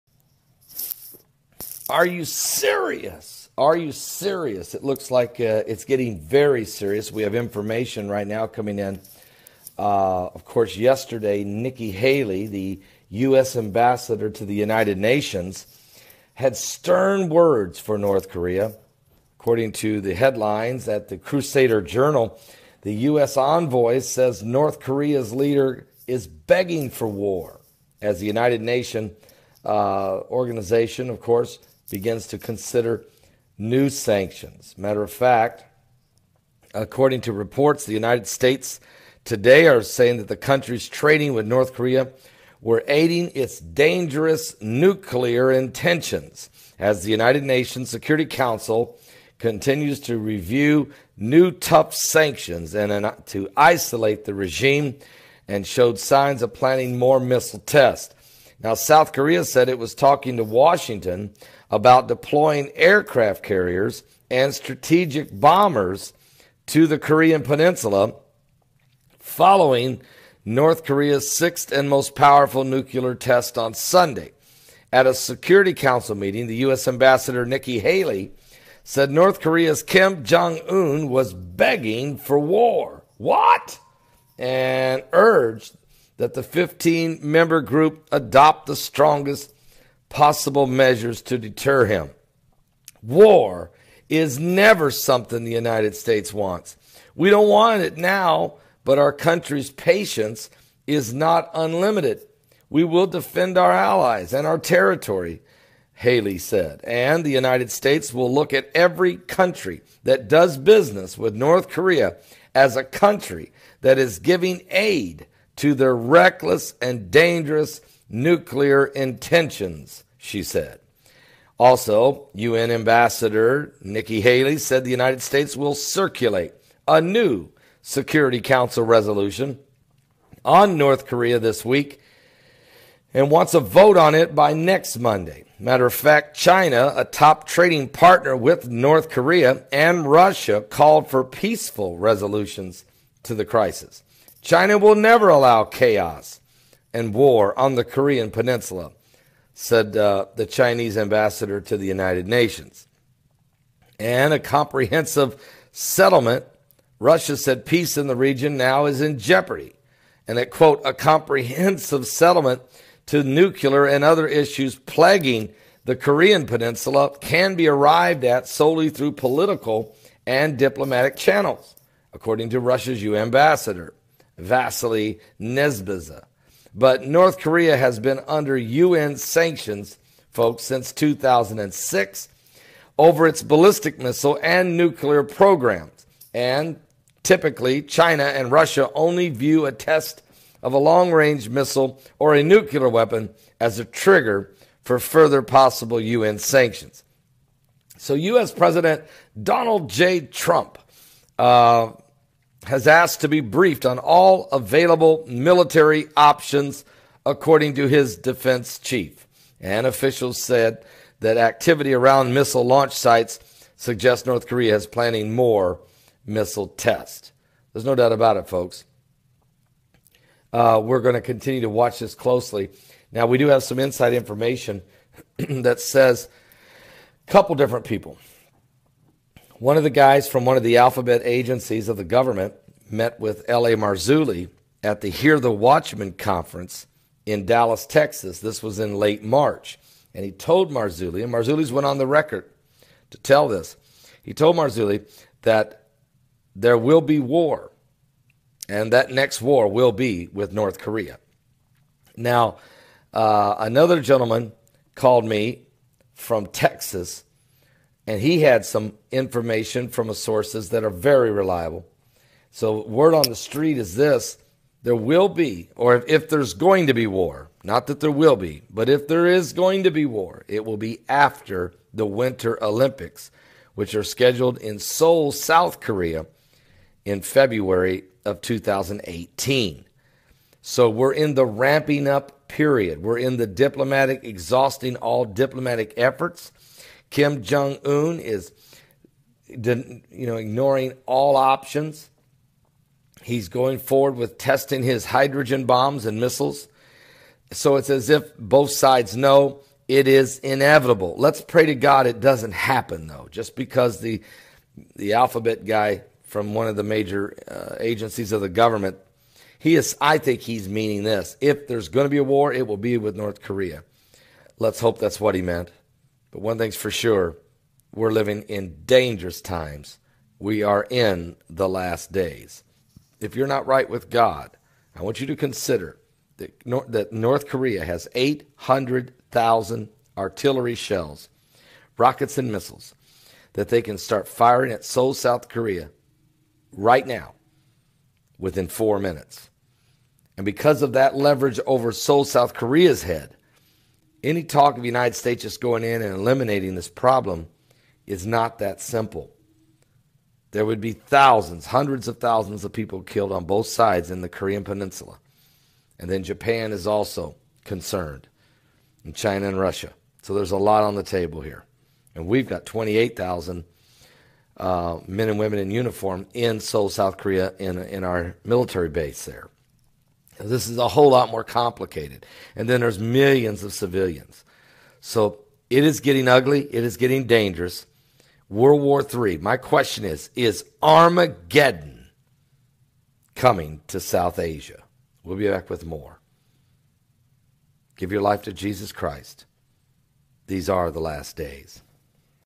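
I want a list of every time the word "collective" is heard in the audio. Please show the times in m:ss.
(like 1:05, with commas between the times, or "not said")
not said.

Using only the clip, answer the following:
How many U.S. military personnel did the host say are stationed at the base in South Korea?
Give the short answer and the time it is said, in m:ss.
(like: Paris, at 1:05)
28,000, at 6:02.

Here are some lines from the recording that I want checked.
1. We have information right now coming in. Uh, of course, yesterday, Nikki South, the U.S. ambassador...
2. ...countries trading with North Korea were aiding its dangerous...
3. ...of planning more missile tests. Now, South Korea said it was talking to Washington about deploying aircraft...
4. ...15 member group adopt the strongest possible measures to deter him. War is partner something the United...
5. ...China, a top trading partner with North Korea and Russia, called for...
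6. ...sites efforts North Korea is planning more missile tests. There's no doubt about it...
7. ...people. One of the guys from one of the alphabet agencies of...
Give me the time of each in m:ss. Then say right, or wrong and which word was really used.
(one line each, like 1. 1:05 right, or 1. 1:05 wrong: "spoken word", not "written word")
1. 0:07 wrong: "Haley", not "South"
2. 0:40 right
3. 0:56 right
4. 1:26 wrong: "never", not "partner"
5. 2:16 right
6. 3:32 wrong: "suggests", not "efforts"
7. 3:47 right.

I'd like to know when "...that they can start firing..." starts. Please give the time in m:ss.
5:33.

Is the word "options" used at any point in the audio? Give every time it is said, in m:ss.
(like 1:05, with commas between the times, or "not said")
3:26, 4:51.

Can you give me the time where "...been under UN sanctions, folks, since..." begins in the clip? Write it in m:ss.
2:57.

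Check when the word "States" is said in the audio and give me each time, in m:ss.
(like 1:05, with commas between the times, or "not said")
0:38, 1:35, 1:47, 2:05, 5:45.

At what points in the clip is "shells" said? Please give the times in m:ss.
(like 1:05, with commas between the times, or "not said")
5:30.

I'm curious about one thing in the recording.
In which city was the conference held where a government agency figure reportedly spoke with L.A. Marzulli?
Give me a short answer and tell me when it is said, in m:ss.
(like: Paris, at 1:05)
Dallas, Texas, at 3:57.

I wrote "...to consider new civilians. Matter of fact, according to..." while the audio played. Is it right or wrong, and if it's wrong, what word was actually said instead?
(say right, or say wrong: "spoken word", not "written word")
wrong: "sanctions", not "civilians".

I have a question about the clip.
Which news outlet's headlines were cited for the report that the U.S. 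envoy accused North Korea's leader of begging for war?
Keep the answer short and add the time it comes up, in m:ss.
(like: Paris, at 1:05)
Crusader Journal, at 0:21.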